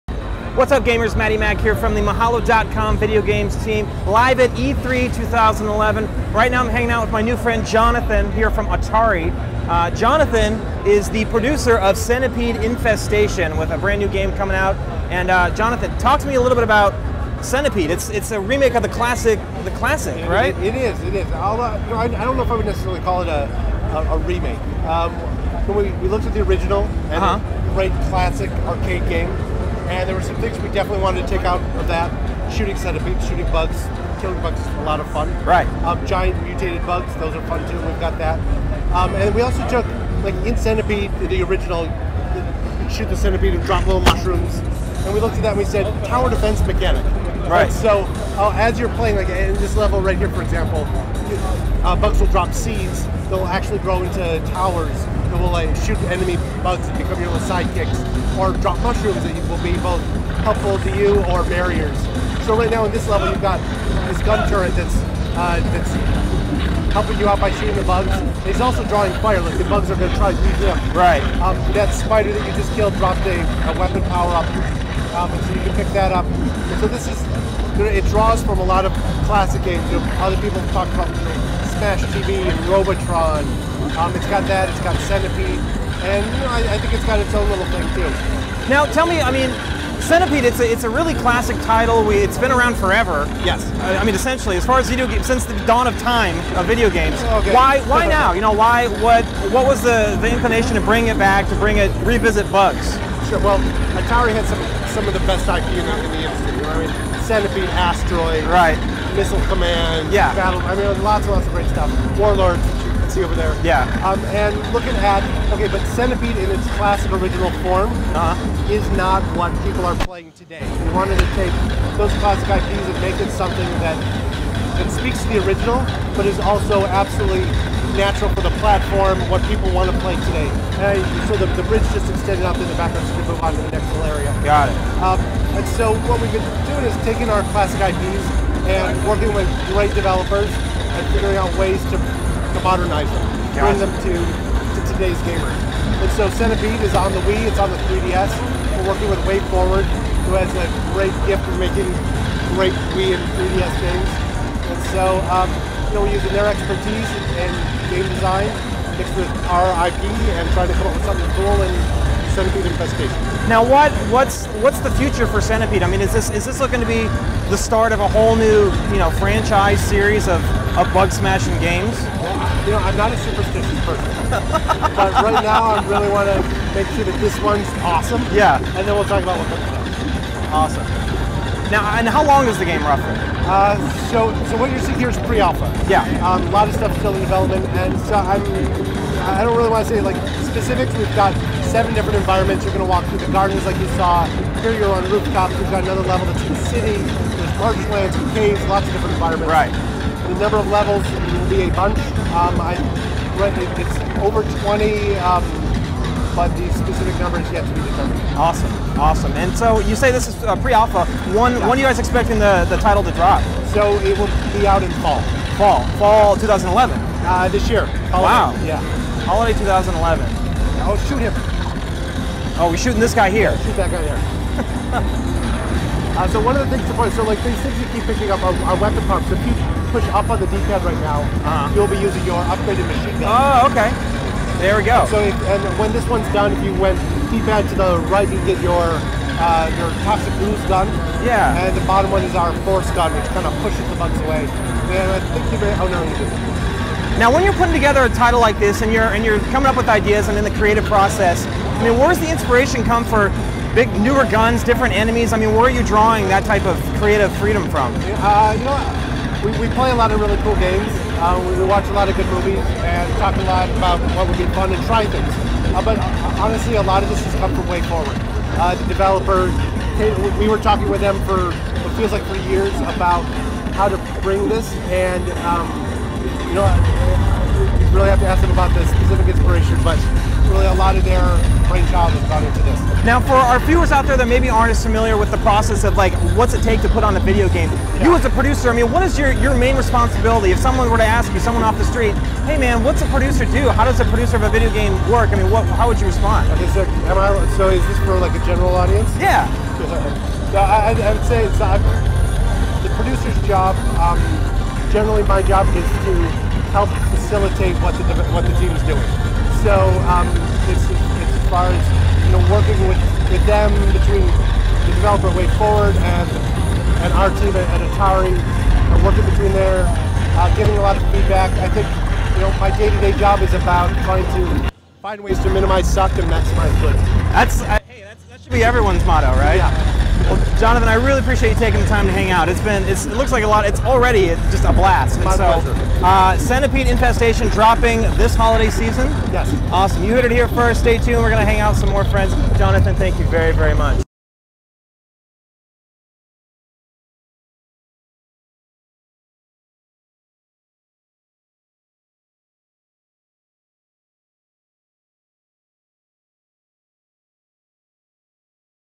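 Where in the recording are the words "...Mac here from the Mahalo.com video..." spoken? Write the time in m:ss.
0:01.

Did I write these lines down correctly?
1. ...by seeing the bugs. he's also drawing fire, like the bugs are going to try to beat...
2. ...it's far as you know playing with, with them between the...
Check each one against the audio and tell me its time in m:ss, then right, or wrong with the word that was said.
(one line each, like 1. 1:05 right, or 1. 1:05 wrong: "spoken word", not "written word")
1. 1:07 wrong: "shooting", not "seeing"
2. 5:10 wrong: "working", not "playing".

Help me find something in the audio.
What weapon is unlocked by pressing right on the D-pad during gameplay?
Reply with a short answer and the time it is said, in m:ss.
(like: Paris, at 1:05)
Toxic ooze gun, at 4:00.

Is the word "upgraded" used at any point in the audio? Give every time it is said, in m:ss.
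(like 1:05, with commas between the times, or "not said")
3:52.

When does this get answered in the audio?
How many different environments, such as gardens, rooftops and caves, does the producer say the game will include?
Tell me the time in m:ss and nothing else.
3:11.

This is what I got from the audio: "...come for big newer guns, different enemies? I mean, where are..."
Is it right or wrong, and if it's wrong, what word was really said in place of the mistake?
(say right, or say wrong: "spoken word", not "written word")
right.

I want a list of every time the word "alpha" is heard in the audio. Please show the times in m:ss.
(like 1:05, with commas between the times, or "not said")
3:05, 3:30.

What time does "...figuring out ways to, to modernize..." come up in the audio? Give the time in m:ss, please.
2:21.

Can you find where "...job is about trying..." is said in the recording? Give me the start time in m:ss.
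5:23.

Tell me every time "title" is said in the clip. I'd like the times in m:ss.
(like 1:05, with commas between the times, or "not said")
1:31, 3:32, 4:08.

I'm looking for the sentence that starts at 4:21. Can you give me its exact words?
Uh, we, watch a lot of good movies and talk a lot about what would be fun and try things.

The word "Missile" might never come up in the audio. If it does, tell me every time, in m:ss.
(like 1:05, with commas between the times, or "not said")
1:49.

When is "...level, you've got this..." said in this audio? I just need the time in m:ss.
1:03.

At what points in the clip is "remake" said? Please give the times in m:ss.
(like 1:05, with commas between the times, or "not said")
0:18, 0:24.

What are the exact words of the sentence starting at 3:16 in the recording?
There's marshlands, caves, lots of different environments.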